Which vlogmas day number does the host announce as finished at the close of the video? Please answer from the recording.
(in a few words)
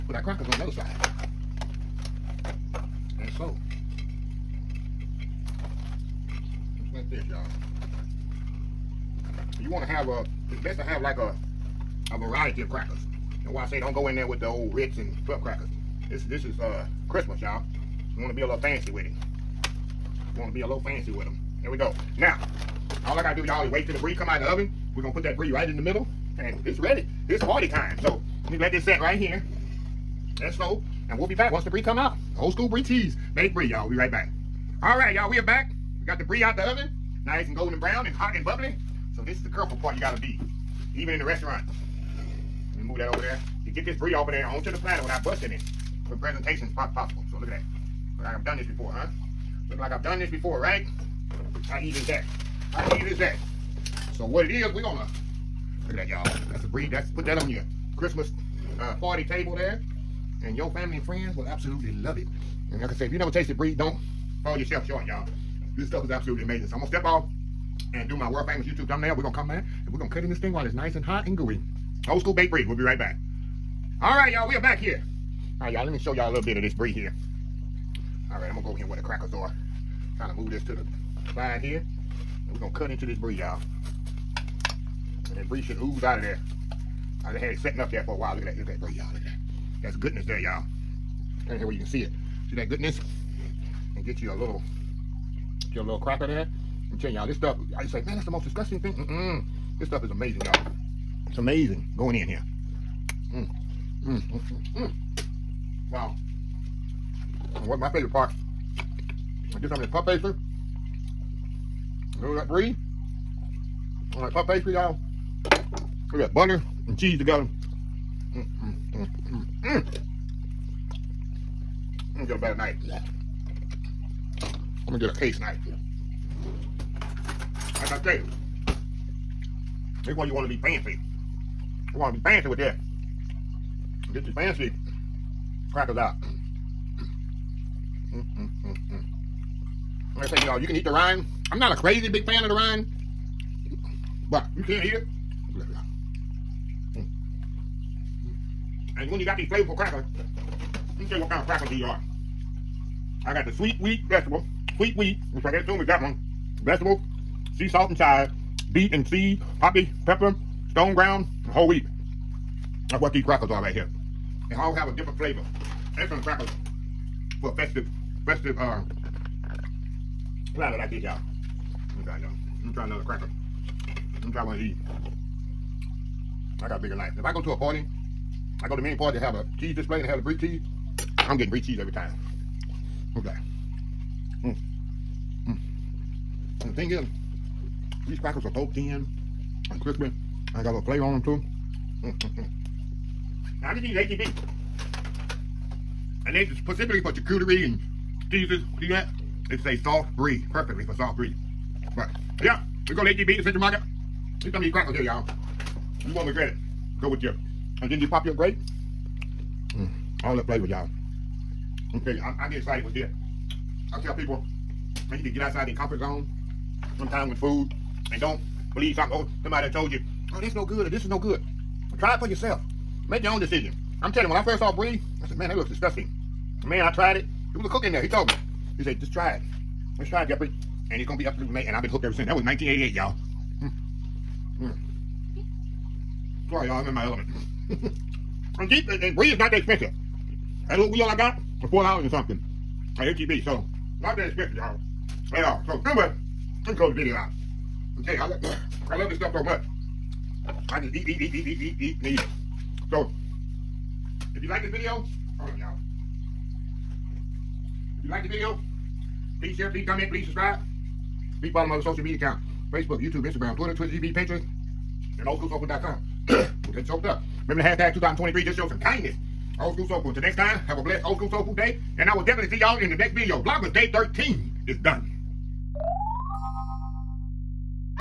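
13.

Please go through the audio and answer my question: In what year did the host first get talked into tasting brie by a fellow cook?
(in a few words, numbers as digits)
1988.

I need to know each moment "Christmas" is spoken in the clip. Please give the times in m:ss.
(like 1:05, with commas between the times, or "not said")
0:17, 0:57.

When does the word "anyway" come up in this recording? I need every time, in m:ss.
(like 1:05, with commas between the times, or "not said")
4:05.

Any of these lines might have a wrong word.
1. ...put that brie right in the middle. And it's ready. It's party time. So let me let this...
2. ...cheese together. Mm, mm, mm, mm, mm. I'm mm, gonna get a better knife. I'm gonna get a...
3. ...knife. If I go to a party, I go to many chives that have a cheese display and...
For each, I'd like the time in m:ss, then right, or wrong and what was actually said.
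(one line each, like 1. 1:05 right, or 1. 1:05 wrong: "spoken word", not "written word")
1. 0:25 right
2. 1:56 right
3. 2:56 wrong: "parties", not "chives".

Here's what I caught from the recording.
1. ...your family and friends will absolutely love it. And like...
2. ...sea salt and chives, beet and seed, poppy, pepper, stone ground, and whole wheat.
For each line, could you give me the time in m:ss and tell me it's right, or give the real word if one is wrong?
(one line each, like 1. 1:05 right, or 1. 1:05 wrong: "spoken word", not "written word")
1. 1:00 right
2. 2:37 right.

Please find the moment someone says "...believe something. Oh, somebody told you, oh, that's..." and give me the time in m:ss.
3:38.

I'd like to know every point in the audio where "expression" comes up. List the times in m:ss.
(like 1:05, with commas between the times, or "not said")
not said.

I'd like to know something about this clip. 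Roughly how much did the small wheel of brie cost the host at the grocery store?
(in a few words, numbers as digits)
$4 and something.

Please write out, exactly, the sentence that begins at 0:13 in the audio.
And why I say don't go in there with the old Ritz and club crackers.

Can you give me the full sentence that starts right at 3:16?
And they specifically for charcuterie and cheeses.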